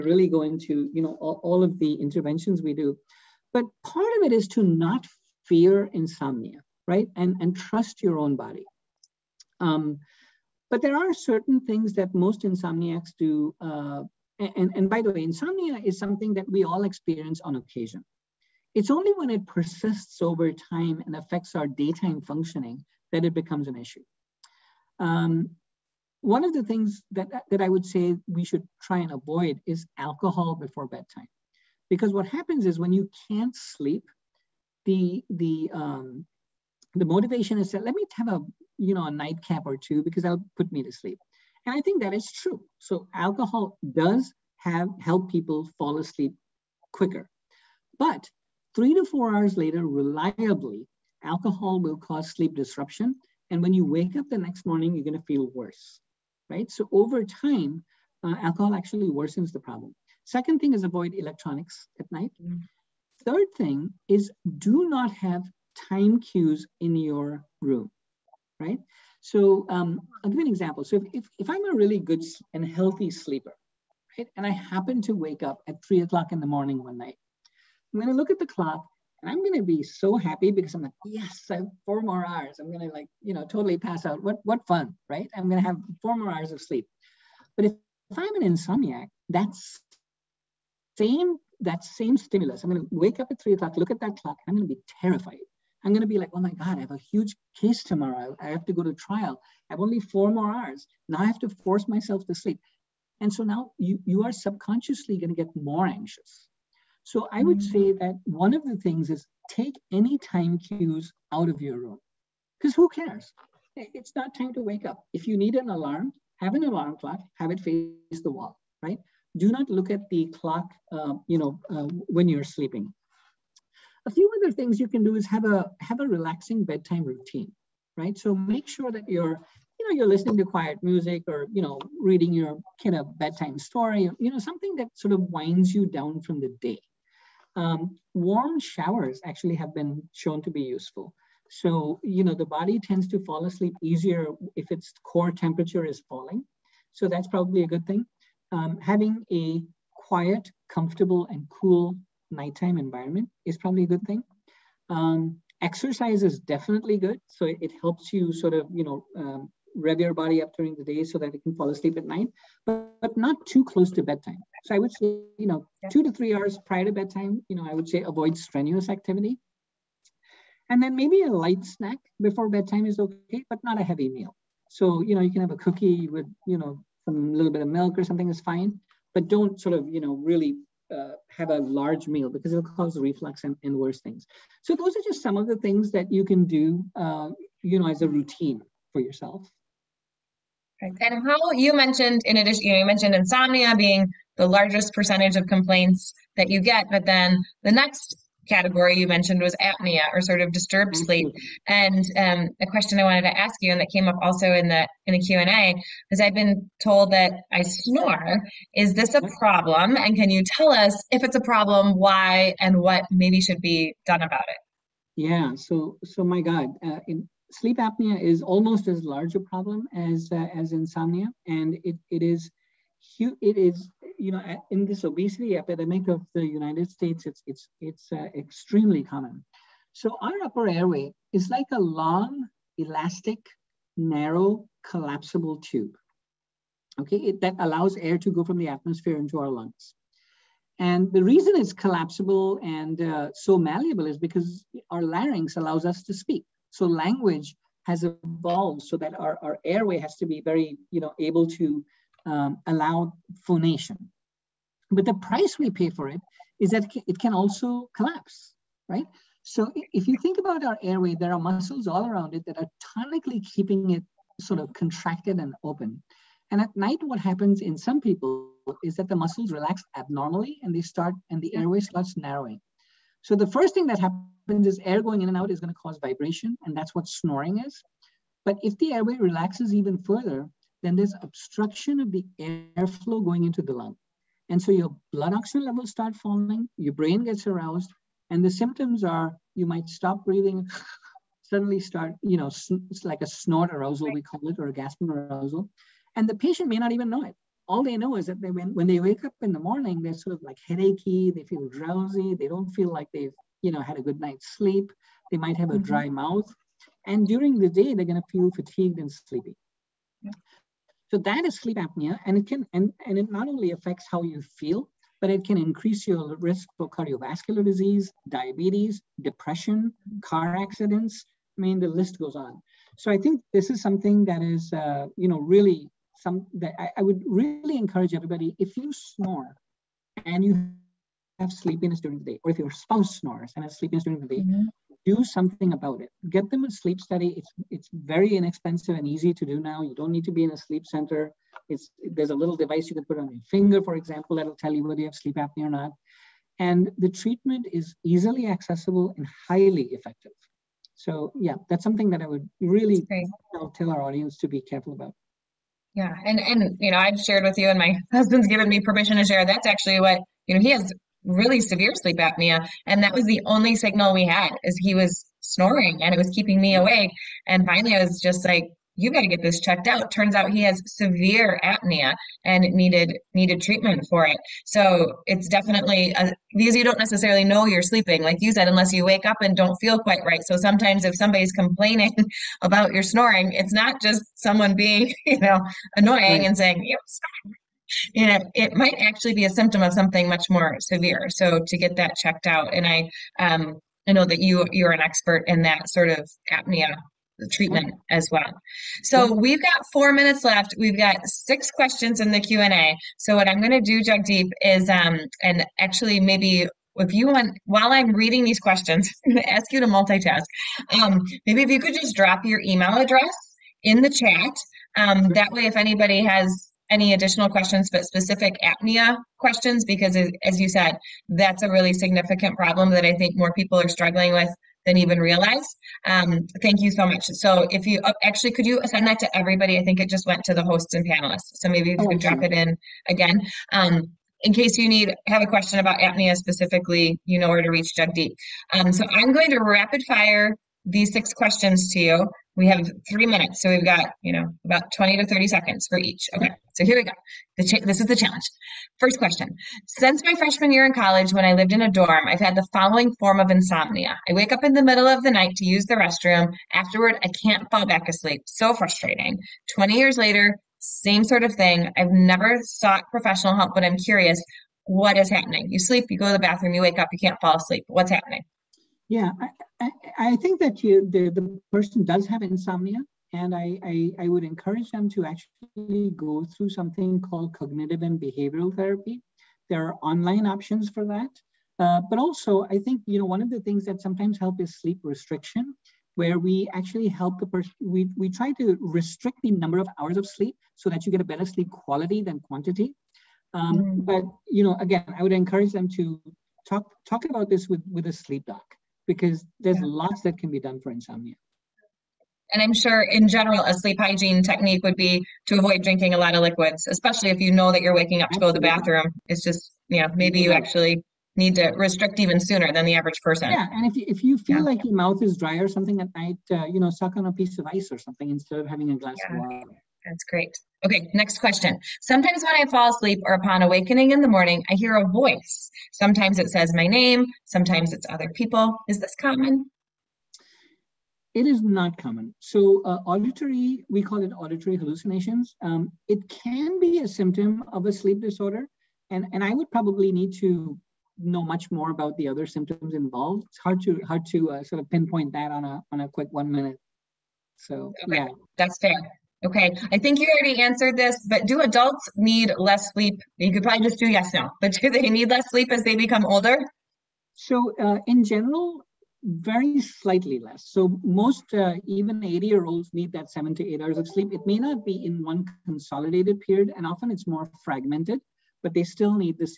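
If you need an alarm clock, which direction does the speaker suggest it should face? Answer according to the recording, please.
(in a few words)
the wall.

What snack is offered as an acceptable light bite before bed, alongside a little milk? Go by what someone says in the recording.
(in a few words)
a cookie.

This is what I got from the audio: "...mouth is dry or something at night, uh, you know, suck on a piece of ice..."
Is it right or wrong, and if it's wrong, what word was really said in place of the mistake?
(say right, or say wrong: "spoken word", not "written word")
right.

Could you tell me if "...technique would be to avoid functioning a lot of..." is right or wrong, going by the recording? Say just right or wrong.
wrong.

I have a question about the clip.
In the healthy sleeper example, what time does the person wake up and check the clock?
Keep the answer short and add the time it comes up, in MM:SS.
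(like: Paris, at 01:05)
3 o'clock, at 01:15.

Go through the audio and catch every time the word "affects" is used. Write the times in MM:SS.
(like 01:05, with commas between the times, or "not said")
00:21, 05:13.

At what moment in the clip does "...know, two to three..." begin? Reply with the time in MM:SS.
02:45.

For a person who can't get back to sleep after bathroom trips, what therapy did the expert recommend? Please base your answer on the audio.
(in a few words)
cognitive and behavioral therapy.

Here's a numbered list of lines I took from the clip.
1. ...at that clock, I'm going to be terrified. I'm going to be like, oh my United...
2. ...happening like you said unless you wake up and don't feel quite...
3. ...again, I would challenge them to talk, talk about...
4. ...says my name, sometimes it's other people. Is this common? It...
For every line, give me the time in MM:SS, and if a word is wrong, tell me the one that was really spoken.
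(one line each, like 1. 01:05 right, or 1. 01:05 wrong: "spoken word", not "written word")
1. 01:33 wrong: "God", not "United"
2. 06:17 wrong: "sleeping", not "happening"
3. 08:14 wrong: "encourage", not "challenge"
4. 08:46 right.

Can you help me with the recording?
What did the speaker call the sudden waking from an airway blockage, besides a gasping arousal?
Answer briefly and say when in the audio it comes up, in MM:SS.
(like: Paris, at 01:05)
snort arousal, at 04:53.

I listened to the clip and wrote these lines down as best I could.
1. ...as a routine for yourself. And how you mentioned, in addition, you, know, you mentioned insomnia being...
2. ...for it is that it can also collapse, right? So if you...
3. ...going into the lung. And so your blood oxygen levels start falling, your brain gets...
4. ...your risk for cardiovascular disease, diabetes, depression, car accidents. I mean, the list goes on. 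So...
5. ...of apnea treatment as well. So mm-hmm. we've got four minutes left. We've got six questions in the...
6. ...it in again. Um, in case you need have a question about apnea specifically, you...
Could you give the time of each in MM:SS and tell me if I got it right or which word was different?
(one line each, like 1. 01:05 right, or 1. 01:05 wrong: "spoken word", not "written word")
1. 03:07 right
2. 04:15 right
3. 04:43 right
4. 05:16 right
5. 06:36 right
6. 07:12 right.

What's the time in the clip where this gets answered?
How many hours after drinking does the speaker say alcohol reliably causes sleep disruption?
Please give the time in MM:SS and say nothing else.
00:48.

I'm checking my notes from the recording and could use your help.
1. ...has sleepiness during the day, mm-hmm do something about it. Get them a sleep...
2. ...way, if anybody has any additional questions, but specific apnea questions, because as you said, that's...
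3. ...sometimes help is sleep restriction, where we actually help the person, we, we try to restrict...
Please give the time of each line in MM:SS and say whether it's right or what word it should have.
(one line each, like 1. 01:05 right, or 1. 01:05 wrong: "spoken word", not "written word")
1. 05:33 right
2. 06:55 right
3. 08:04 right.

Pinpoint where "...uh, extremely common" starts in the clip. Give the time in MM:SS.
03:48.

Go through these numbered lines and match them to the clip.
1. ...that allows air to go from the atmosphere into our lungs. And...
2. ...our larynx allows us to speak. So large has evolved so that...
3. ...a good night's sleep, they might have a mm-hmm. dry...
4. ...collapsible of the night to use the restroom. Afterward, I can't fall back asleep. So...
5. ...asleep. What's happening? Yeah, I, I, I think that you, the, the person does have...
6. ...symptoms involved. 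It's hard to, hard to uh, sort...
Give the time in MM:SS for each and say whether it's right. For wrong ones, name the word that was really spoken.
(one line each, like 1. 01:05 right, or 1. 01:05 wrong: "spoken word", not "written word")
1. 03:57 right
2. 04:04 wrong: "language", not "large"
3. 05:03 right
4. 07:34 wrong: "middle", not "collapsible"
5. 07:47 right
6. 09:02 right.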